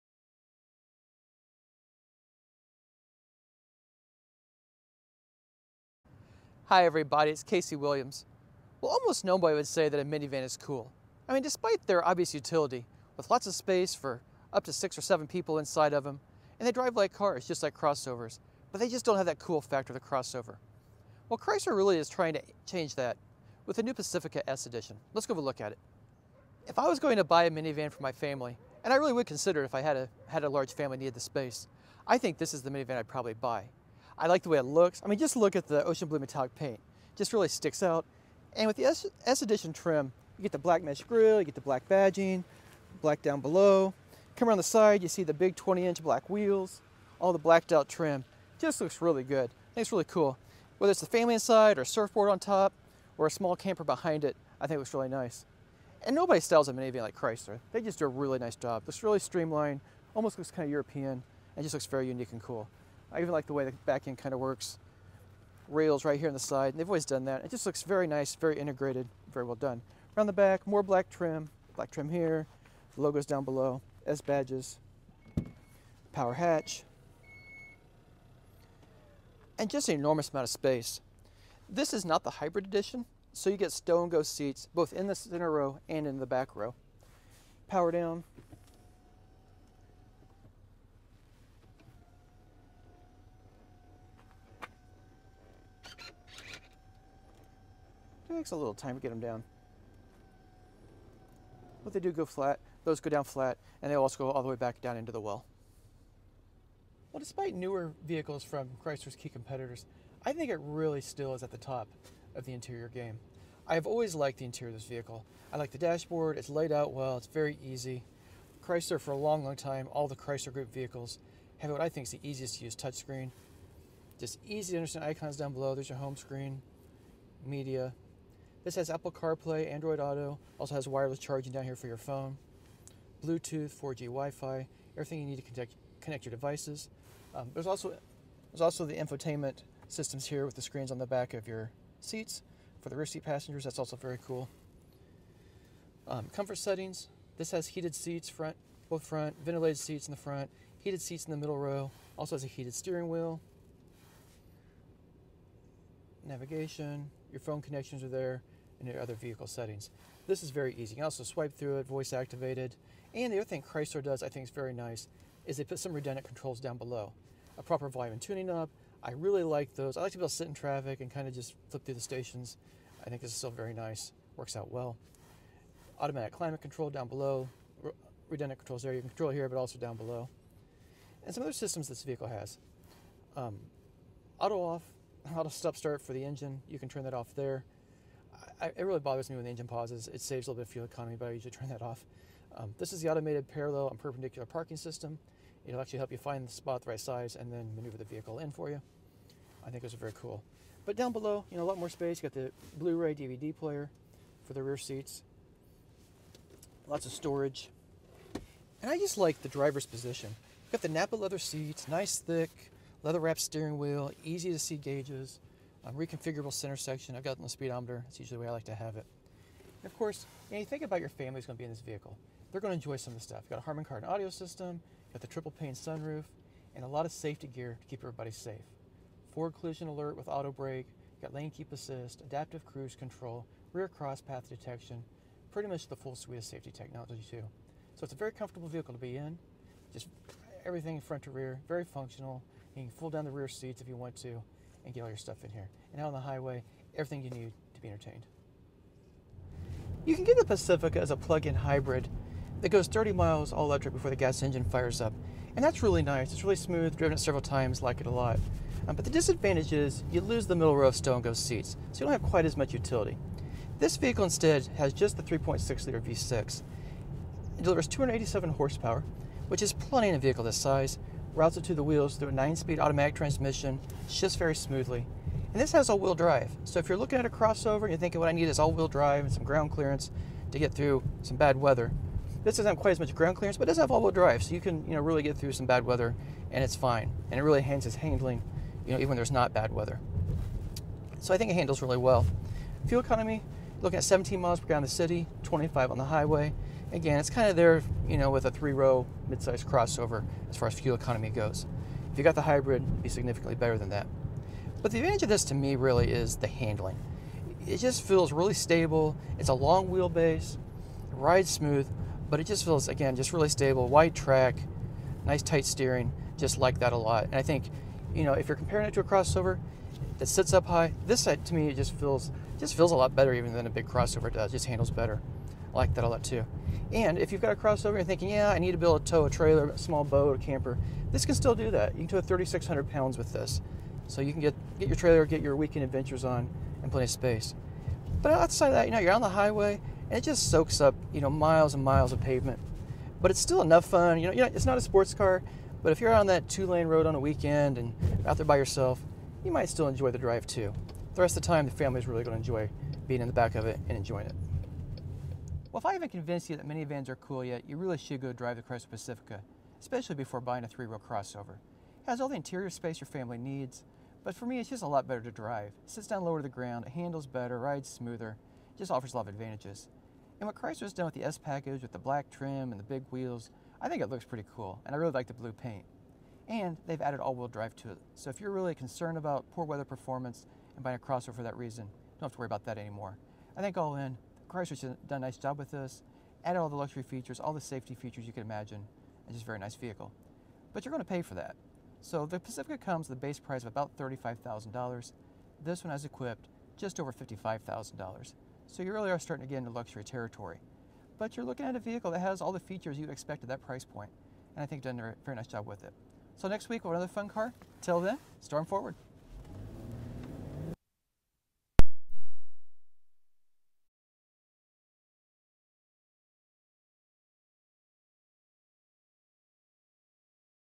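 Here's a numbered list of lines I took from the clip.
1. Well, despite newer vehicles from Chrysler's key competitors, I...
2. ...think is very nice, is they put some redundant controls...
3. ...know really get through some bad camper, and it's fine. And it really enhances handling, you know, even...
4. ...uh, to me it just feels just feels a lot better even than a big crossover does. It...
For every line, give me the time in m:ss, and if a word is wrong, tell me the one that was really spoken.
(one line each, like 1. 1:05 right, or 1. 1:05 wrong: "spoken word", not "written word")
1. 1:47 right
2. 2:44 right
3. 4:44 wrong: "weather", not "camper"
4. 5:21 right.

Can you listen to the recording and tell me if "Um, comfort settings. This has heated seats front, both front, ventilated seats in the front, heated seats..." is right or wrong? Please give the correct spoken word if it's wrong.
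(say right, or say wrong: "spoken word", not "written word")
right.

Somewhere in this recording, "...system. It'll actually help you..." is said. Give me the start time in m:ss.
3:14.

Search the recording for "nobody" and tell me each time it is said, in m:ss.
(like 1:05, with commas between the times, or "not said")
0:09, 0:56.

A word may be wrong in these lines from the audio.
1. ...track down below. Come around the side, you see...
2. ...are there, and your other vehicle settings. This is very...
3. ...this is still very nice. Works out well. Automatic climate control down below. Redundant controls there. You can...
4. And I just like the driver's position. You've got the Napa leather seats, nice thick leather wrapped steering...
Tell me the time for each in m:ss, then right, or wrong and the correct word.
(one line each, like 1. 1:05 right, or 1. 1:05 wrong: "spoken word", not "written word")
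1. 0:43 wrong: "black", not "track"
2. 2:38 right
3. 2:53 right
4. 3:28 right.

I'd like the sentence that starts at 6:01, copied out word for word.
It has all the interior space your family needs, but for me it's just a lot better to drive.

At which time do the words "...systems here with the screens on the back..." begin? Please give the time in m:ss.
2:19.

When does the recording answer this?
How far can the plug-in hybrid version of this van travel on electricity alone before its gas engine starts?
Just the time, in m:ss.
4:12.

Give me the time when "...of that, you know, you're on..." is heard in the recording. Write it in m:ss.
5:38.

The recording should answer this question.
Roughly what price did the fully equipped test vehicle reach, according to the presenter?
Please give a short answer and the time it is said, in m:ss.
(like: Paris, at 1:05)
just over $55,000, at 6:36.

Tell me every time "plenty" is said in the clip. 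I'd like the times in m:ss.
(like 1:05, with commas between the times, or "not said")
4:29, 5:36.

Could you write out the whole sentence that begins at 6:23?
I think all in, Chrysler's done a nice job with this.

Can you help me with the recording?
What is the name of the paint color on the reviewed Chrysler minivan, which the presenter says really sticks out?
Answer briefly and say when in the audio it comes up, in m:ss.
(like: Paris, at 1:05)
ocean blue metallic, at 0:35.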